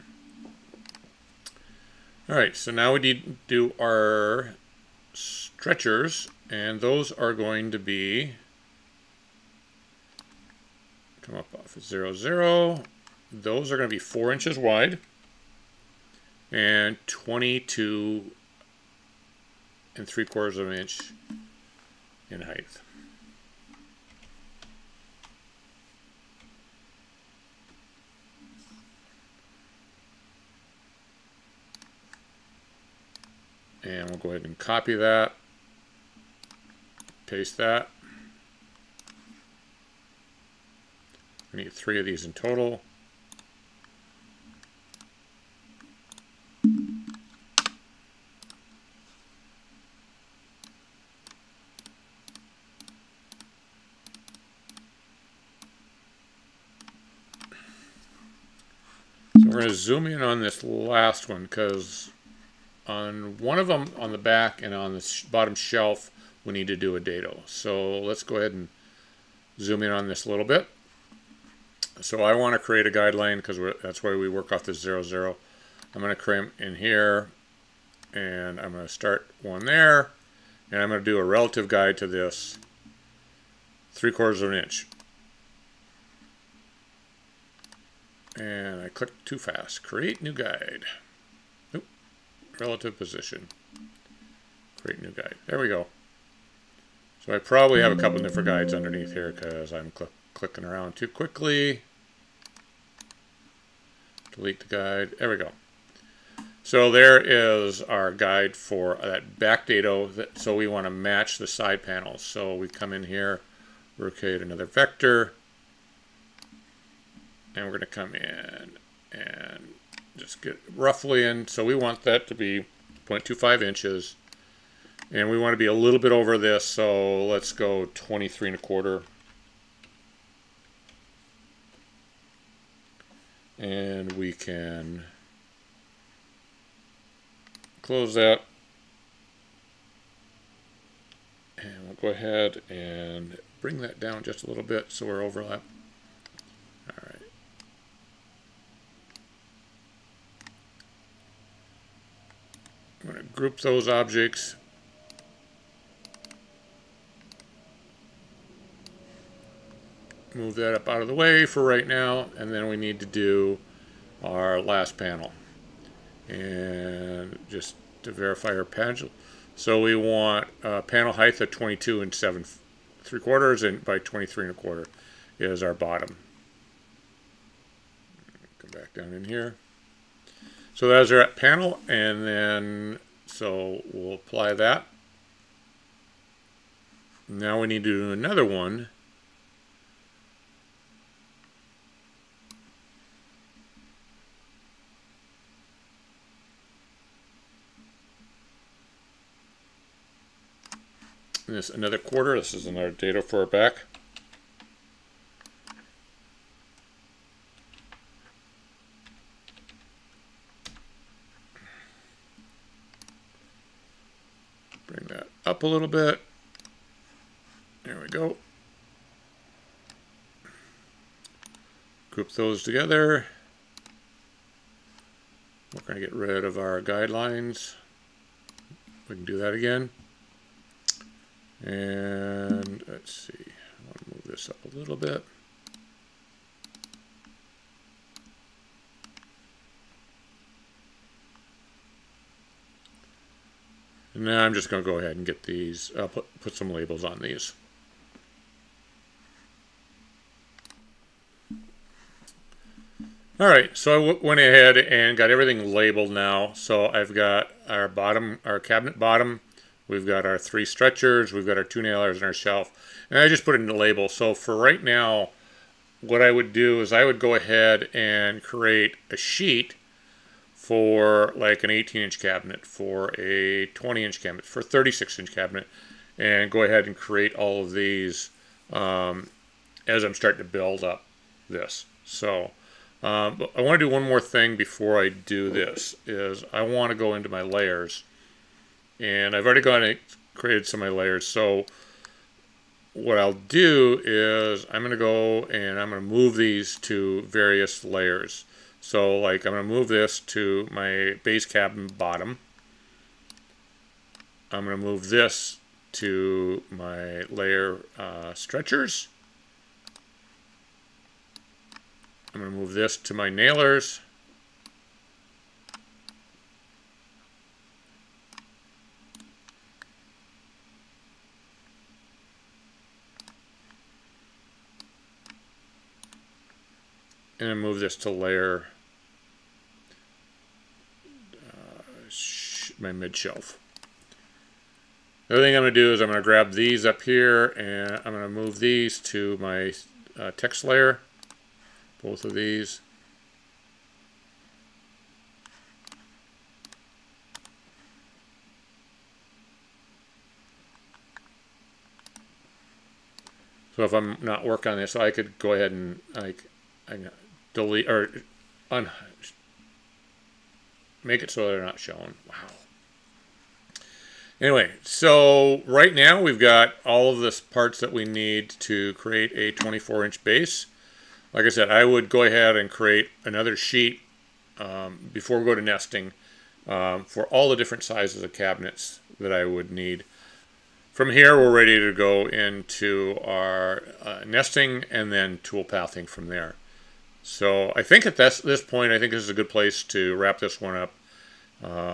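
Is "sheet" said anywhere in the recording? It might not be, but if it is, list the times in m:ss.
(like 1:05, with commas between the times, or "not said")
4:29, 6:13.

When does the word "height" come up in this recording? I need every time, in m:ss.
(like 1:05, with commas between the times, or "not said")
0:22, 2:51.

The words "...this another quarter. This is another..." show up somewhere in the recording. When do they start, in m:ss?
3:21.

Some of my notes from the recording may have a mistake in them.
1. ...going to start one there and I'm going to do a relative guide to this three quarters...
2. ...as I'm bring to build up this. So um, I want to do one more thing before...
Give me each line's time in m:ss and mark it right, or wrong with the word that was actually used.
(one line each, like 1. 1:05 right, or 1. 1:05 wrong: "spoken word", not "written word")
1. 1:18 right
2. 4:39 wrong: "starting", not "bring".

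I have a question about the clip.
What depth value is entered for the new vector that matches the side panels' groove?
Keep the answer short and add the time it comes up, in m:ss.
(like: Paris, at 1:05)
0.25 inches, at 2:03.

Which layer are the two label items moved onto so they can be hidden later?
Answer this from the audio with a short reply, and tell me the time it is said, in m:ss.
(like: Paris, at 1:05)
text layer, at 5:40.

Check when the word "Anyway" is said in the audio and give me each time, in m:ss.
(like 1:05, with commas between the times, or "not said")
6:04.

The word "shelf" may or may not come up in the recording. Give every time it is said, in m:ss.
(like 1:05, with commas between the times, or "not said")
1:05, 4:22, 5:33.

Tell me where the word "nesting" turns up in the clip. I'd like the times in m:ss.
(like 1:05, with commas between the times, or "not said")
6:15, 6:24.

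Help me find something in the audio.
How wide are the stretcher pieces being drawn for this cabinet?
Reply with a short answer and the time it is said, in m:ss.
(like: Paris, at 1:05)
4 inches, at 0:13.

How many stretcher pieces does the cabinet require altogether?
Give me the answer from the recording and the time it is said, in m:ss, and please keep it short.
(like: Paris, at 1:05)
3, at 0:41.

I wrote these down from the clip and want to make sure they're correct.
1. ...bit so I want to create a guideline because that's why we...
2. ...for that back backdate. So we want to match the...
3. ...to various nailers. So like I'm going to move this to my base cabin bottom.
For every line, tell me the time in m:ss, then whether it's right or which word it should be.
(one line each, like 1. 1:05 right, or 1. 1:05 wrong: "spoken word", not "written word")
1. 1:10 right
2. 1:48 right
3. 4:56 wrong: "layers", not "nailers".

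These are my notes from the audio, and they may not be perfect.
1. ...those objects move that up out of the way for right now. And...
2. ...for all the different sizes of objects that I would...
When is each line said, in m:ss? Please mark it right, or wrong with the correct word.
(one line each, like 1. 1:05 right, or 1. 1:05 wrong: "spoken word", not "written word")
1. 2:33 right
2. 6:17 wrong: "cabinets", not "objects".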